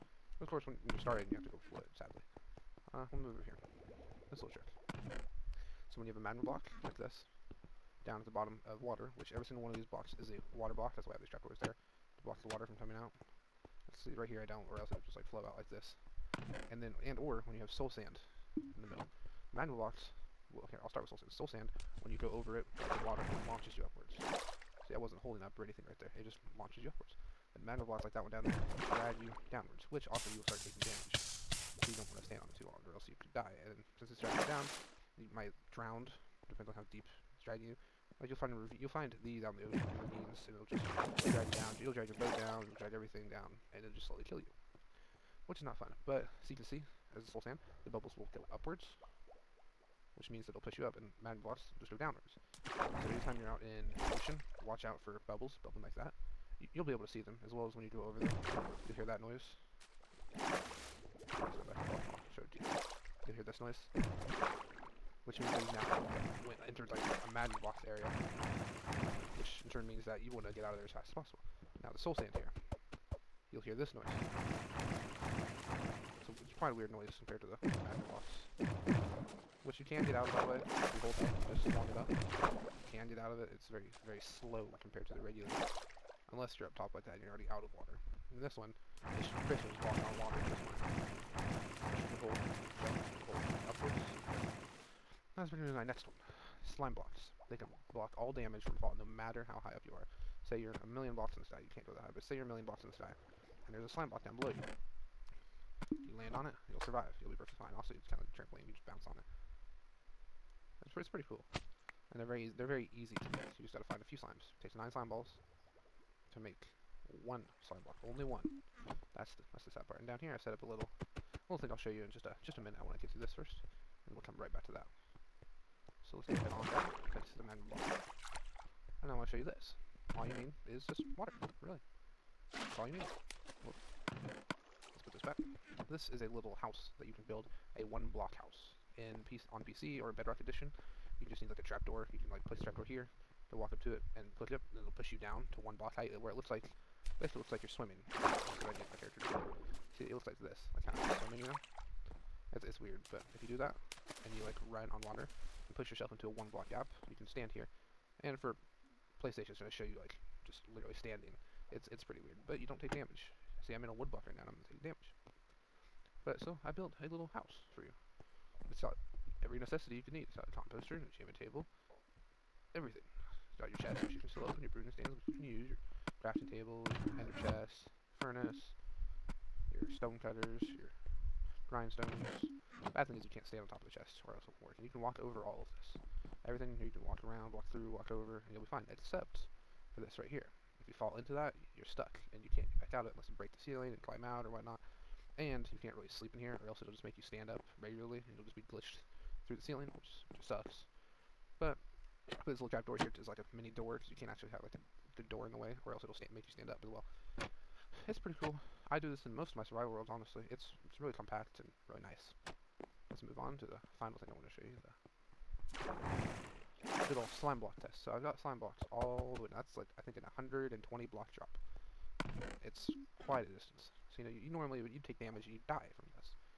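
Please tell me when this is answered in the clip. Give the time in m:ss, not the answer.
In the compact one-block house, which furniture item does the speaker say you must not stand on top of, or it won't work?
3:03.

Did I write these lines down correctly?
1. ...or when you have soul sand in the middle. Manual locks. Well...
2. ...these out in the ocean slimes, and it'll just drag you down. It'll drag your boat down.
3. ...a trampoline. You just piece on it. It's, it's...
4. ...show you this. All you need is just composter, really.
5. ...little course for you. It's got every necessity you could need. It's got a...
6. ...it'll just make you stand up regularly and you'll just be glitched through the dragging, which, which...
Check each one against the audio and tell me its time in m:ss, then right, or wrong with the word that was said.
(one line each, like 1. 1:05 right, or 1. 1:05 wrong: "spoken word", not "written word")
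1. 0:17 right
2. 0:39 wrong: "ravines", not "slimes"
3. 1:48 wrong: "bounce", not "piece"
4. 2:09 wrong: "water", not "composter"
5. 2:47 wrong: "house", not "course"
6. 3:16 wrong: "ceiling", not "dragging".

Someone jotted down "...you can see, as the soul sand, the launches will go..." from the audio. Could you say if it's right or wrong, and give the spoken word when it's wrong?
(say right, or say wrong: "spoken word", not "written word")
wrong: "bubbles", not "launches".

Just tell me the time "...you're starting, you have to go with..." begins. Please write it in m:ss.
0:00.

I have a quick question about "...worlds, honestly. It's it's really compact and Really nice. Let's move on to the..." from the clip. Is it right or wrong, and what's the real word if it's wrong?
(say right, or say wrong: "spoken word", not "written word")
right.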